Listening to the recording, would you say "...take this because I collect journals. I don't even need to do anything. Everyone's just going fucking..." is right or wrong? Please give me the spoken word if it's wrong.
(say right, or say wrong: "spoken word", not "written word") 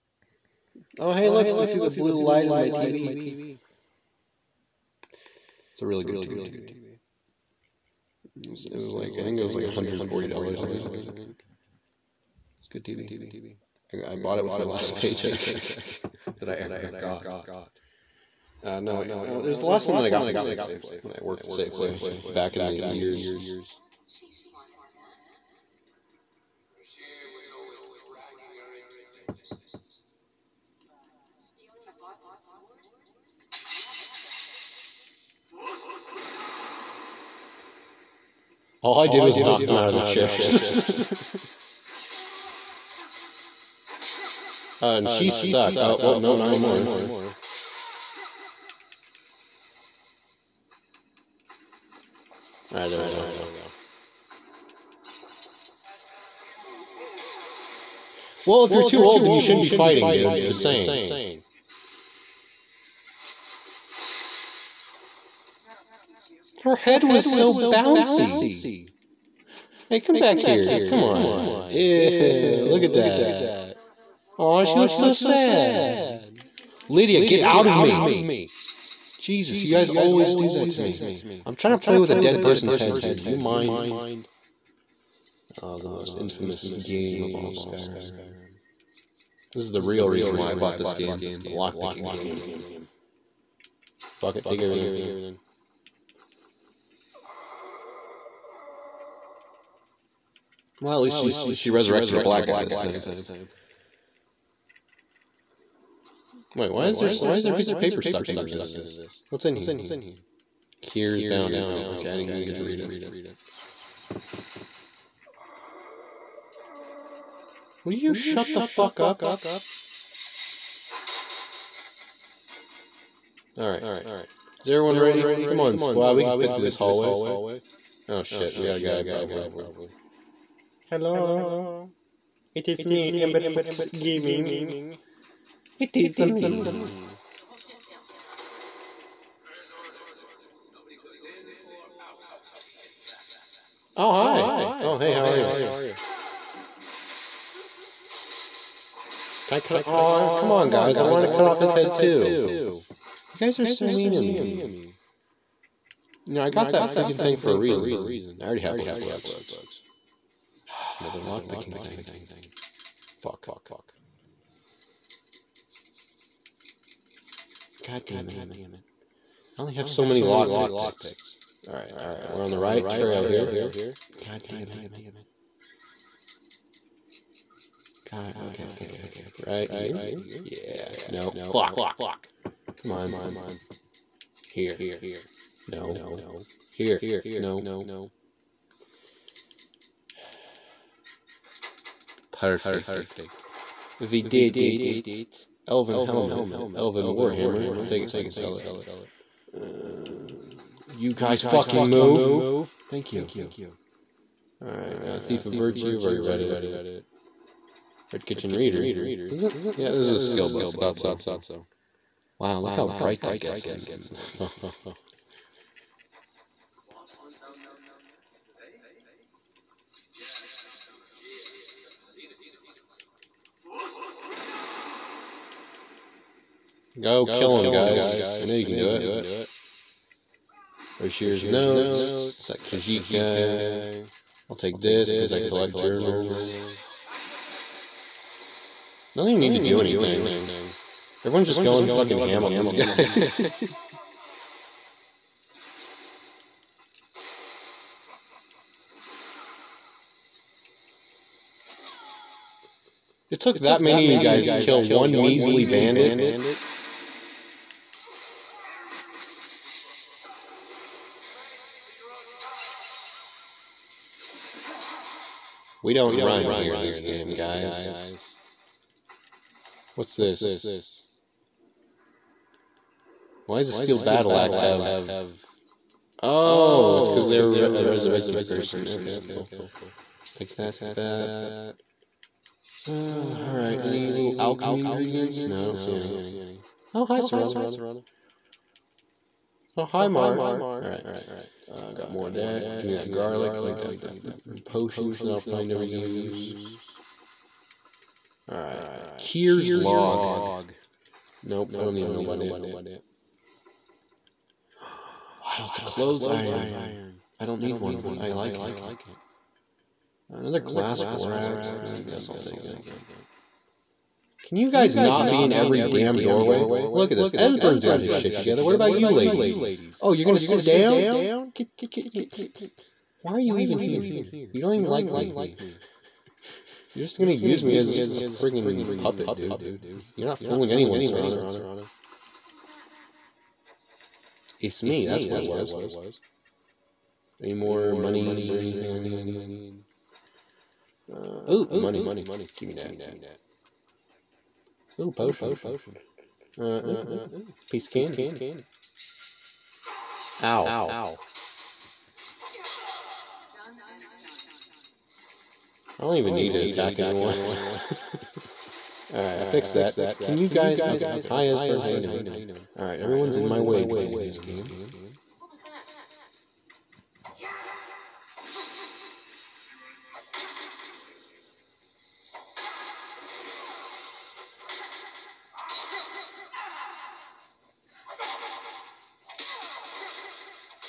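right.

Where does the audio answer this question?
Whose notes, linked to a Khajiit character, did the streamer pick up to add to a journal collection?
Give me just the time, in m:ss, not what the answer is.
3:50.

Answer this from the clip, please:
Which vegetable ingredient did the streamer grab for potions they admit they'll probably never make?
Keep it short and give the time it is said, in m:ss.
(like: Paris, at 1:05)
Garlic, at 4:53.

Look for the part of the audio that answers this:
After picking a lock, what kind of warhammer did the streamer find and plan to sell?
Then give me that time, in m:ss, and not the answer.
3:16.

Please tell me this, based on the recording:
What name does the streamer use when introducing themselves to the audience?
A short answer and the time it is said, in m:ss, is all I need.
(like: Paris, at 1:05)
Ember Fox Gaming, at 2:13.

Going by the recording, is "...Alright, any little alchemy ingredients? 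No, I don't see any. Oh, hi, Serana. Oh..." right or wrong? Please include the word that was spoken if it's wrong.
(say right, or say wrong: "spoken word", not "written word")
right.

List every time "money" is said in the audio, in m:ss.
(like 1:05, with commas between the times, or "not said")
5:41.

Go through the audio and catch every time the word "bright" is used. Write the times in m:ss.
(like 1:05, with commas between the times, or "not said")
3:32.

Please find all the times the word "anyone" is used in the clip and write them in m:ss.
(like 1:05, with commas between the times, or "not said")
5:30, 5:56.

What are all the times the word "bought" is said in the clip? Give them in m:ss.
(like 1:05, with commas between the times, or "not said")
0:14, 1:30.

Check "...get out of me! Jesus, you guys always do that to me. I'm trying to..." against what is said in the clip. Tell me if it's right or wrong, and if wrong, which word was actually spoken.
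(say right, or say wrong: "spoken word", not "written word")
right.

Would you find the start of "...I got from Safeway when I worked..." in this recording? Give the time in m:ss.
0:20.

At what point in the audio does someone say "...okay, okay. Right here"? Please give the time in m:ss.
2:58.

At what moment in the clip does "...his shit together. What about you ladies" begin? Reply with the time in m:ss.
5:18.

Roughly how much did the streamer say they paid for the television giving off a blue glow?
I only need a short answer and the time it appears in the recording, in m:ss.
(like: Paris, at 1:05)
$140, at 0:09.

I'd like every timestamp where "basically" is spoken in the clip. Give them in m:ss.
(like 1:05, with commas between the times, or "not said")
not said.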